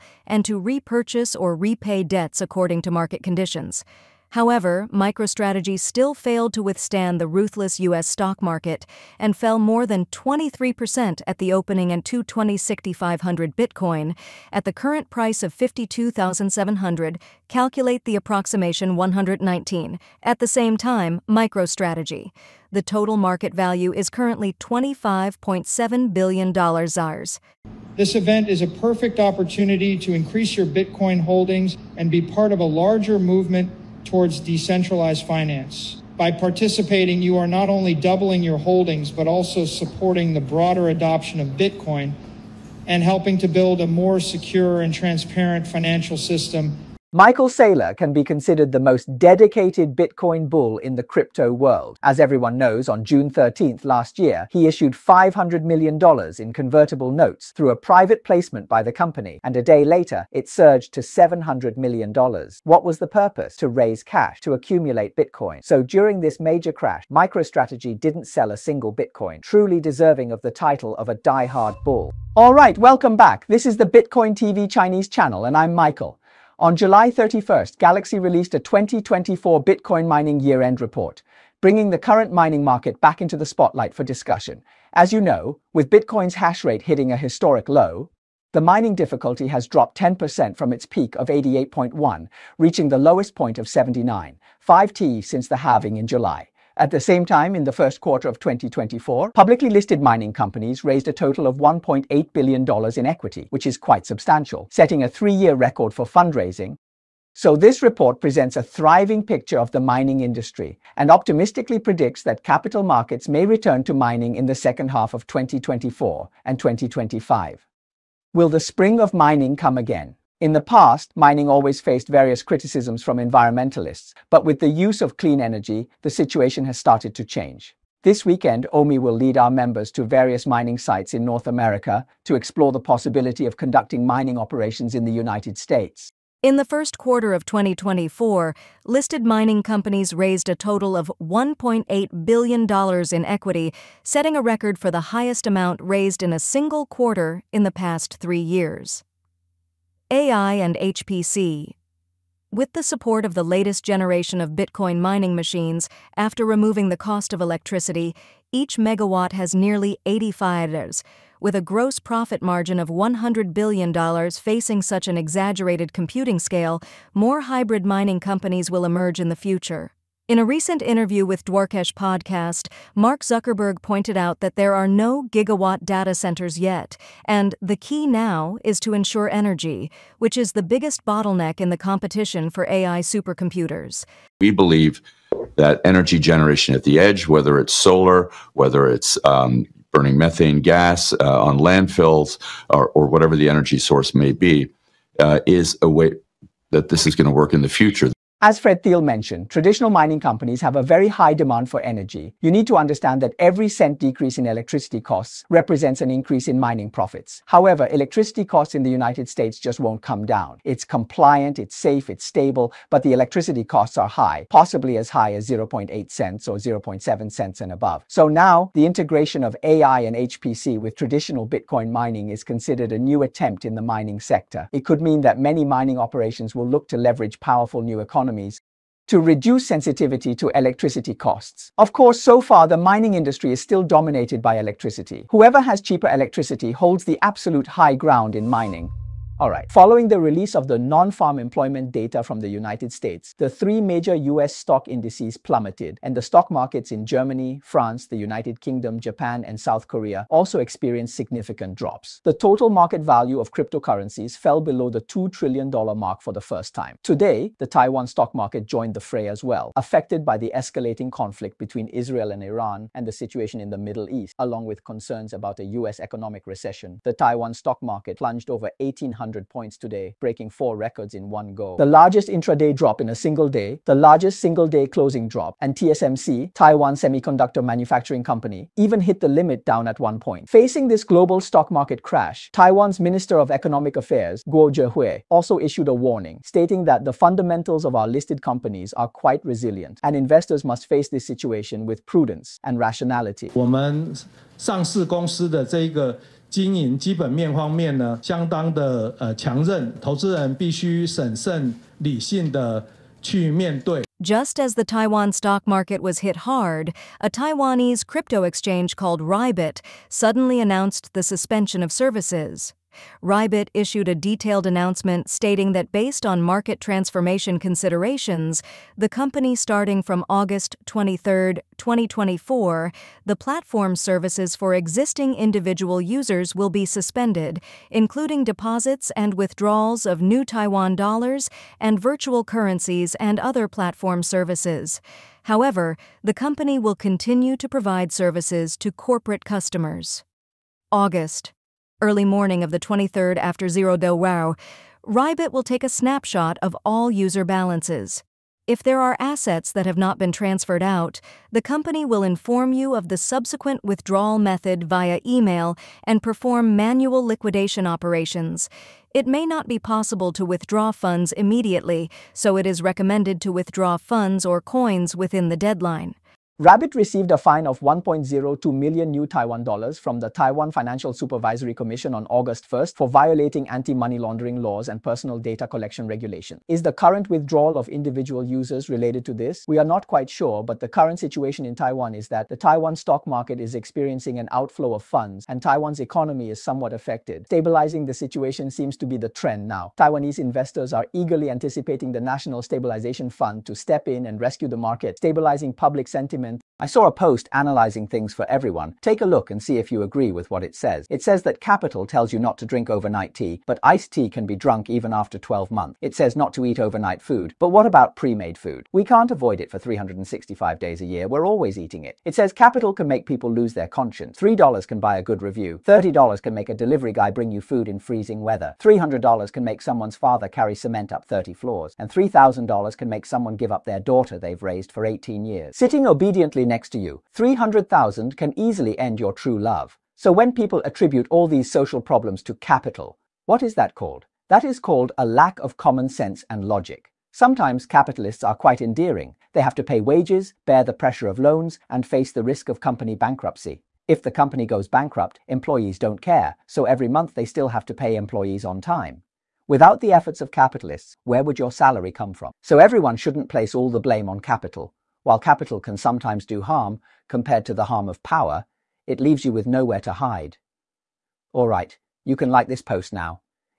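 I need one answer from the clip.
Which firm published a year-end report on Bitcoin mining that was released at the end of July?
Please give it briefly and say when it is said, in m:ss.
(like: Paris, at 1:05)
Galaxy, at 1:17.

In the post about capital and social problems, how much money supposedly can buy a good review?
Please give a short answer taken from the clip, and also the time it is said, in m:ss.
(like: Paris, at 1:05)
$3, at 6:54.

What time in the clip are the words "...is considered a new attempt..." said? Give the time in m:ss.
3:42.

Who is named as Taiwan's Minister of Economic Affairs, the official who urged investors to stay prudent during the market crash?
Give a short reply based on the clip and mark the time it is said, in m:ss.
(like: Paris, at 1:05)
Guo Zhehui, at 4:44.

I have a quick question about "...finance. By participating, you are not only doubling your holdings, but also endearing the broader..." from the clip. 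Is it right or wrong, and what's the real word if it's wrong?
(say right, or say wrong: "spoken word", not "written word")
wrong: "supporting", not "endearing".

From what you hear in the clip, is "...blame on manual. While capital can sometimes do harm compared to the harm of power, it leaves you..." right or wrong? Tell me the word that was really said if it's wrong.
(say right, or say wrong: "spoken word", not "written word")
wrong: "capital", not "manual".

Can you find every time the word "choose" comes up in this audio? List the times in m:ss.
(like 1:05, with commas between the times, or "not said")
not said.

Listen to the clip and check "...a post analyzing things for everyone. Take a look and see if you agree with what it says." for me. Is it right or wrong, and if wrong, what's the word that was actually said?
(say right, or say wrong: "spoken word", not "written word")
right.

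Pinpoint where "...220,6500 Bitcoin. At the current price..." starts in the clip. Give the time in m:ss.
0:12.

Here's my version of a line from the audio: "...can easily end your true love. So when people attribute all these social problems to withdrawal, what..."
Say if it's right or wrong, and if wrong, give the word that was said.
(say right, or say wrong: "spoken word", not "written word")
wrong: "capital", not "withdrawal".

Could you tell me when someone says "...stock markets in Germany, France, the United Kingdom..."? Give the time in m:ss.
4:06.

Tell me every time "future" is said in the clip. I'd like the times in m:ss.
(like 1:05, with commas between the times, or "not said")
2:49, 3:17.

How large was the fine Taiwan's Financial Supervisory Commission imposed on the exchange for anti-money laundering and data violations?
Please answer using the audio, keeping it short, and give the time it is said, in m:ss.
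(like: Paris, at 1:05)
1.02 million new Taiwan dollars, at 6:07.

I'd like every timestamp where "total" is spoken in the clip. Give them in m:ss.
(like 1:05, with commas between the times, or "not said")
0:22, 1:41, 2:20, 4:12.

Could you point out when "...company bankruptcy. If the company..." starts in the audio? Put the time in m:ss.
7:22.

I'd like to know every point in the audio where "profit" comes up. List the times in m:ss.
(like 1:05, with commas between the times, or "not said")
2:42, 3:26.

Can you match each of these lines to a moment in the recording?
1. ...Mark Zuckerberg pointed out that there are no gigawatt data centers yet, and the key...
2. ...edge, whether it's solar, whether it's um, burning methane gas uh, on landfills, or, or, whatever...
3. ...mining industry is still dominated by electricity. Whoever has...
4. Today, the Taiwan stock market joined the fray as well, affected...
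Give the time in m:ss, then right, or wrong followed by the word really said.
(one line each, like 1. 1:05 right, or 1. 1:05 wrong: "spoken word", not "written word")
1. 2:52 right
2. 3:06 right
3. 3:52 right
4. 4:17 right.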